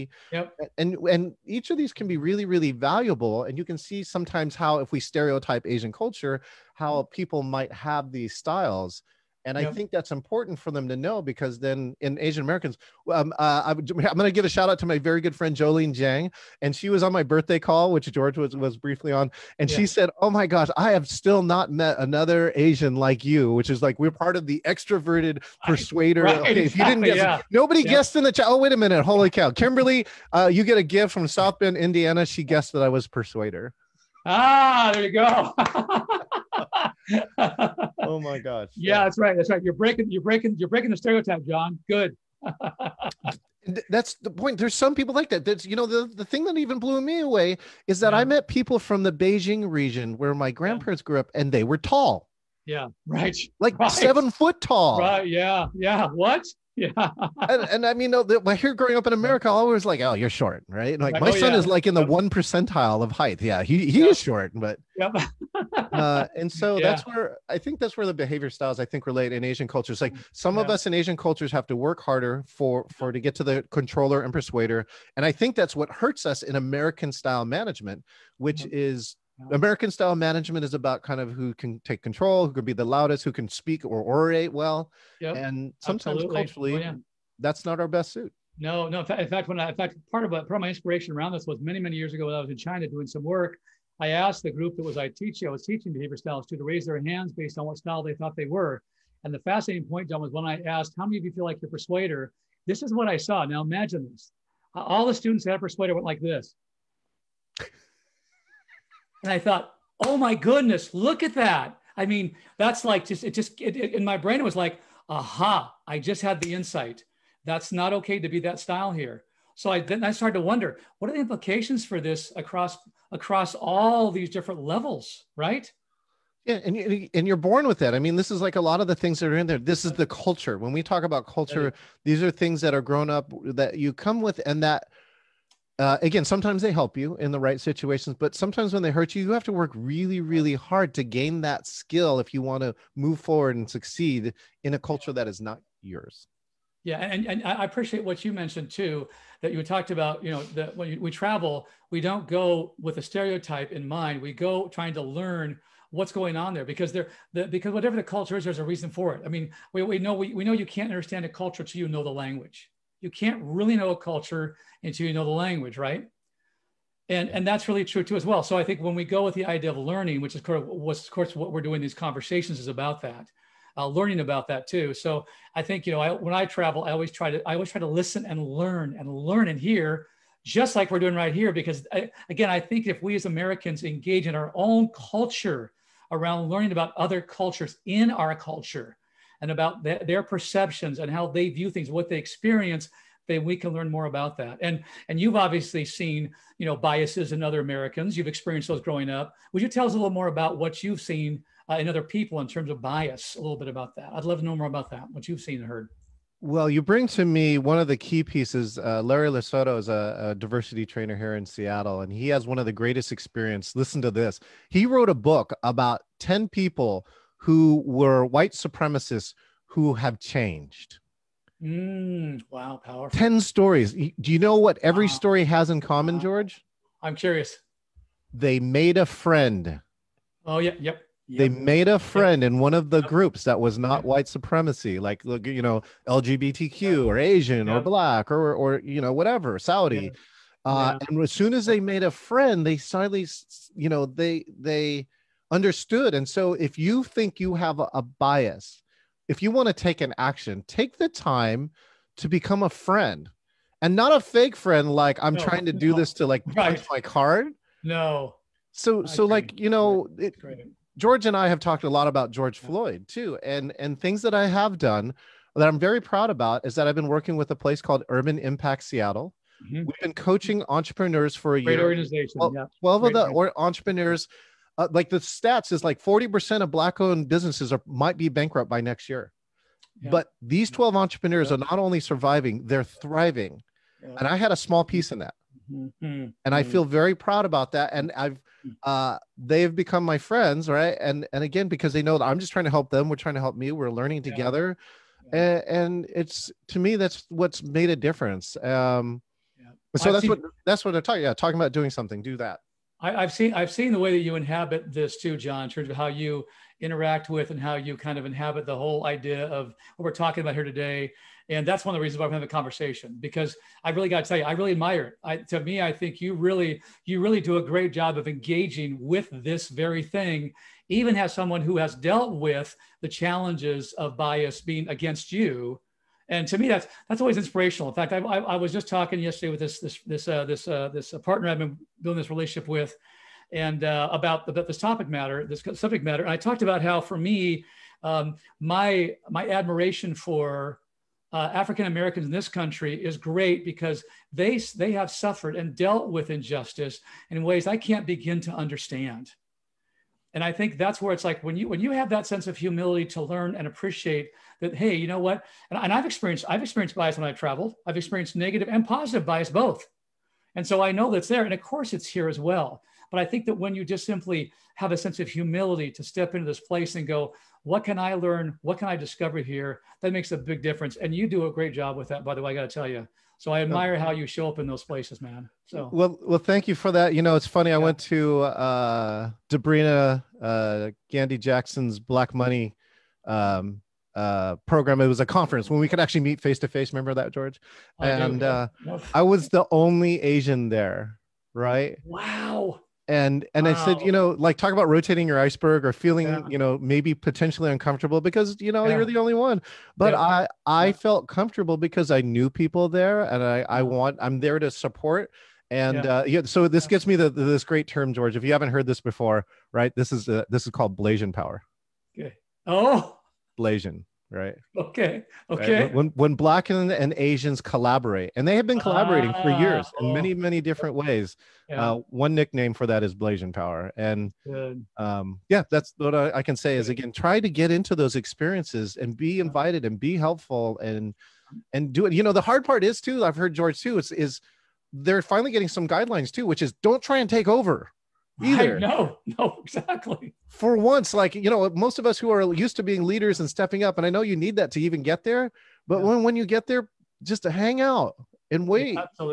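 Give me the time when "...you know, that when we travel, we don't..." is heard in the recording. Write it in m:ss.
2:30.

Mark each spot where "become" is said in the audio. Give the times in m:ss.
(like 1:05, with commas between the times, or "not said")
4:12, 4:49.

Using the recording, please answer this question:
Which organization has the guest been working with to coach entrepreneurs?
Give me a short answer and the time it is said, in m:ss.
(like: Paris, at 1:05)
Urban Impact Seattle, at 4:28.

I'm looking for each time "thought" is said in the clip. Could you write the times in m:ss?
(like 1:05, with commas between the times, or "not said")
1:38, 1:49.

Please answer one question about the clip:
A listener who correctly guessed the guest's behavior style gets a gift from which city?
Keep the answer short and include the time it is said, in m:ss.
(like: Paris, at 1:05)
South Bend, Indiana, at 0:31.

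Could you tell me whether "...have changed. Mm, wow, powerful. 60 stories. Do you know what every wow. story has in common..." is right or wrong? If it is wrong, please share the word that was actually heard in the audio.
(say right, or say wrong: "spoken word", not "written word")
wrong: "10", not "60".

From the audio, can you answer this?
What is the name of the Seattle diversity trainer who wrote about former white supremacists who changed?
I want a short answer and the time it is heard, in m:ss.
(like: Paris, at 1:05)
Larry Lesoto, at 3:29.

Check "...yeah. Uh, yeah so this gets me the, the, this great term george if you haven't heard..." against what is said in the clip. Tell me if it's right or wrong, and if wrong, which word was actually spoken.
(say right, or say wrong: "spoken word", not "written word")
right.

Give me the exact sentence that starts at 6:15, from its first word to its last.
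So well, well, thank you for that.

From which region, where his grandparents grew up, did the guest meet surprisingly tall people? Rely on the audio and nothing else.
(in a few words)
Beijing.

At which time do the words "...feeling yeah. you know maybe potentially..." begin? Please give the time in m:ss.
6:35.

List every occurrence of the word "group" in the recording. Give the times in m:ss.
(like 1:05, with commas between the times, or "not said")
1:34, 3:53.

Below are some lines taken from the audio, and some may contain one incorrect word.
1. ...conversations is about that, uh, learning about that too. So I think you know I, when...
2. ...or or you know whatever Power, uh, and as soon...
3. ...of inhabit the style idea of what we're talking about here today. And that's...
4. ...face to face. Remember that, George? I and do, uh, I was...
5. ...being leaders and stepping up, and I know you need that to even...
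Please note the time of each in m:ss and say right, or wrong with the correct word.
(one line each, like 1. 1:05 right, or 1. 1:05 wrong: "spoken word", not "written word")
1. 2:51 right
2. 3:58 wrong: "Saudi", not "Power"
3. 5:08 wrong: "whole", not "style"
4. 6:26 right
5. 7:22 right.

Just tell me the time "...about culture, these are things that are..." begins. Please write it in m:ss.
2:11.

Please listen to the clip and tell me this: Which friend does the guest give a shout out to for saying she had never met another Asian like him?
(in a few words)
Jolene Jang.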